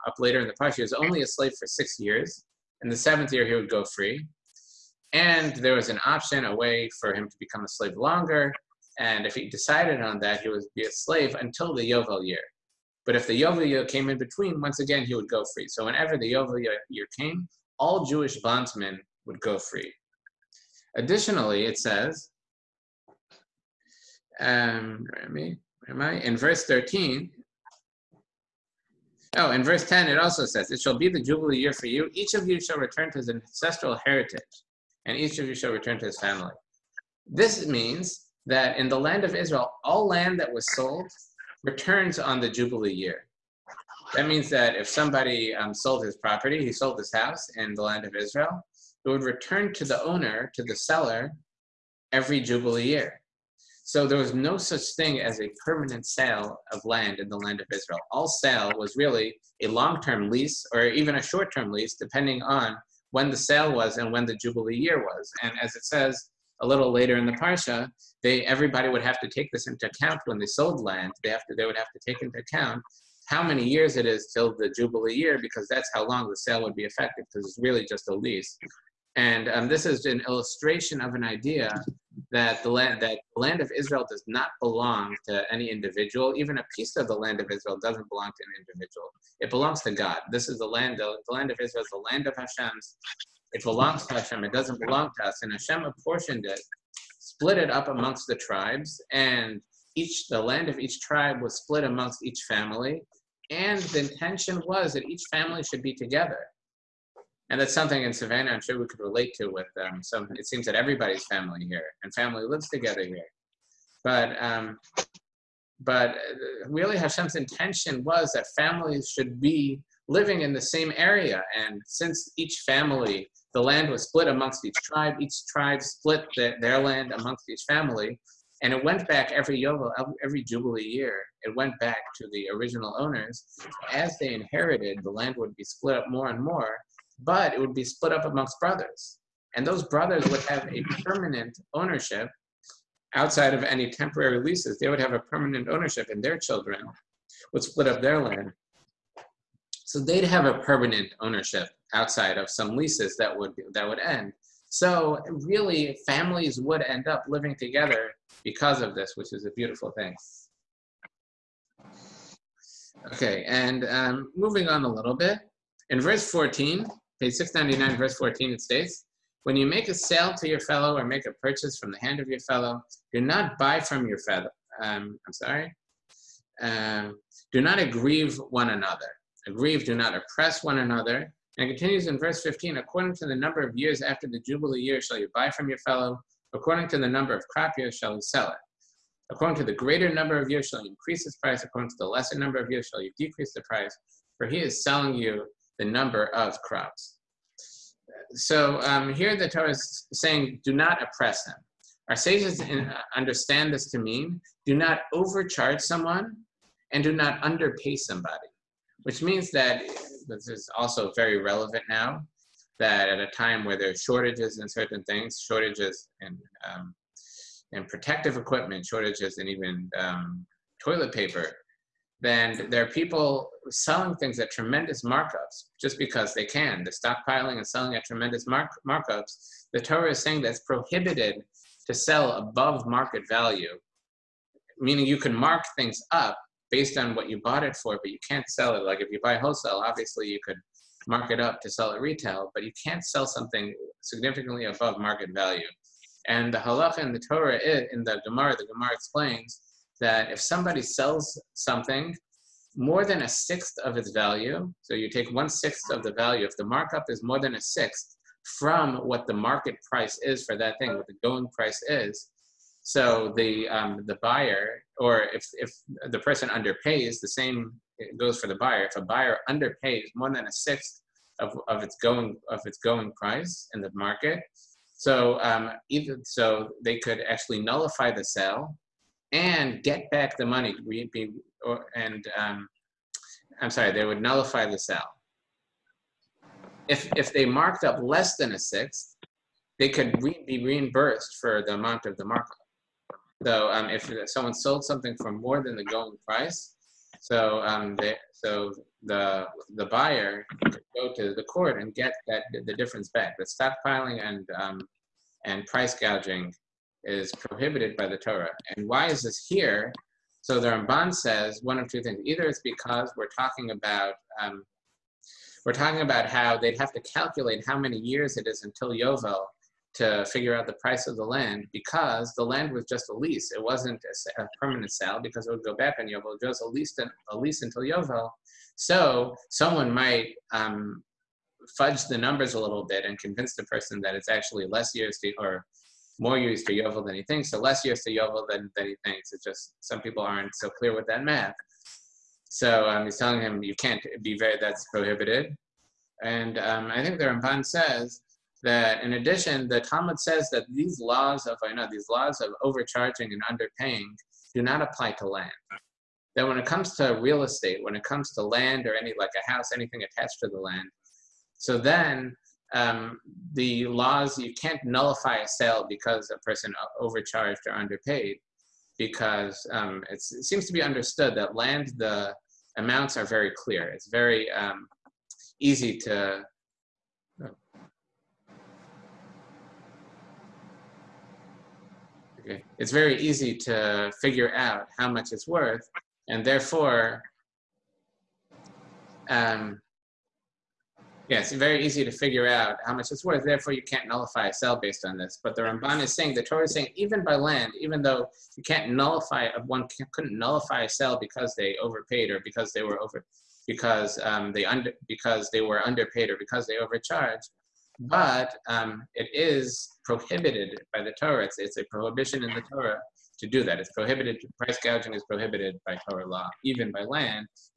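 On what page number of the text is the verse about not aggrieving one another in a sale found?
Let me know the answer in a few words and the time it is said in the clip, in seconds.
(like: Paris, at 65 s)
699, at 167 s.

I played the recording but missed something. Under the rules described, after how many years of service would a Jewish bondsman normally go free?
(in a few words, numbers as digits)
6.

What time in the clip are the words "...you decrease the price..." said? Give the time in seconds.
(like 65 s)
193 s.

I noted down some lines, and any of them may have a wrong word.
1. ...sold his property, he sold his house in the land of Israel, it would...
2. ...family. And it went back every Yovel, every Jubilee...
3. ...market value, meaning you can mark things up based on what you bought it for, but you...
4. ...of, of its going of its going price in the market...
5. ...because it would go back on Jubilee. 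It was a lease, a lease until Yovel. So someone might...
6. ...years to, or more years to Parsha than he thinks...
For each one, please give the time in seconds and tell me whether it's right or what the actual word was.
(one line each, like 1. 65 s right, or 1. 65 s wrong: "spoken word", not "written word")
1. 45 s right
2. 127 s right
3. 232 s right
4. 271 s right
5. 325 s wrong: "Yovel", not "Jubilee"
6. 334 s wrong: "Yovel", not "Parsha".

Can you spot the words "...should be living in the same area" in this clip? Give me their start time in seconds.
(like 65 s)
119 s.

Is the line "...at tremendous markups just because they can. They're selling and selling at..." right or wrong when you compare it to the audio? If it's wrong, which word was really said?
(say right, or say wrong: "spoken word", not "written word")
wrong: "stockpiling", not "selling".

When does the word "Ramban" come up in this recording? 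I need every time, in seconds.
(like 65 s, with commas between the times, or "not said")
310 s, 347 s, 395 s.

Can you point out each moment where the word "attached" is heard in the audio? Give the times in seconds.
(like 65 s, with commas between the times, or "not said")
360 s.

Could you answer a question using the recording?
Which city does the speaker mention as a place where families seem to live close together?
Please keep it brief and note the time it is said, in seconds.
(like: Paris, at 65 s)
Savannah, at 108 s.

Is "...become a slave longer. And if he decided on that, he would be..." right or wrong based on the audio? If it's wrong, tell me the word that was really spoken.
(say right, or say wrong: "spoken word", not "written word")
right.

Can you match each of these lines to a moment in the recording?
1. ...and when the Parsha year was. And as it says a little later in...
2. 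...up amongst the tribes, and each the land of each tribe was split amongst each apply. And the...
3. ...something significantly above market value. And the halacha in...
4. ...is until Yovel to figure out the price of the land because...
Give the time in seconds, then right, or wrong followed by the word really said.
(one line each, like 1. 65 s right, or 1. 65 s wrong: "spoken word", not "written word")
1. 63 s wrong: "Jubilee", not "Parsha"
2. 97 s wrong: "family", not "apply"
3. 243 s right
4. 318 s right.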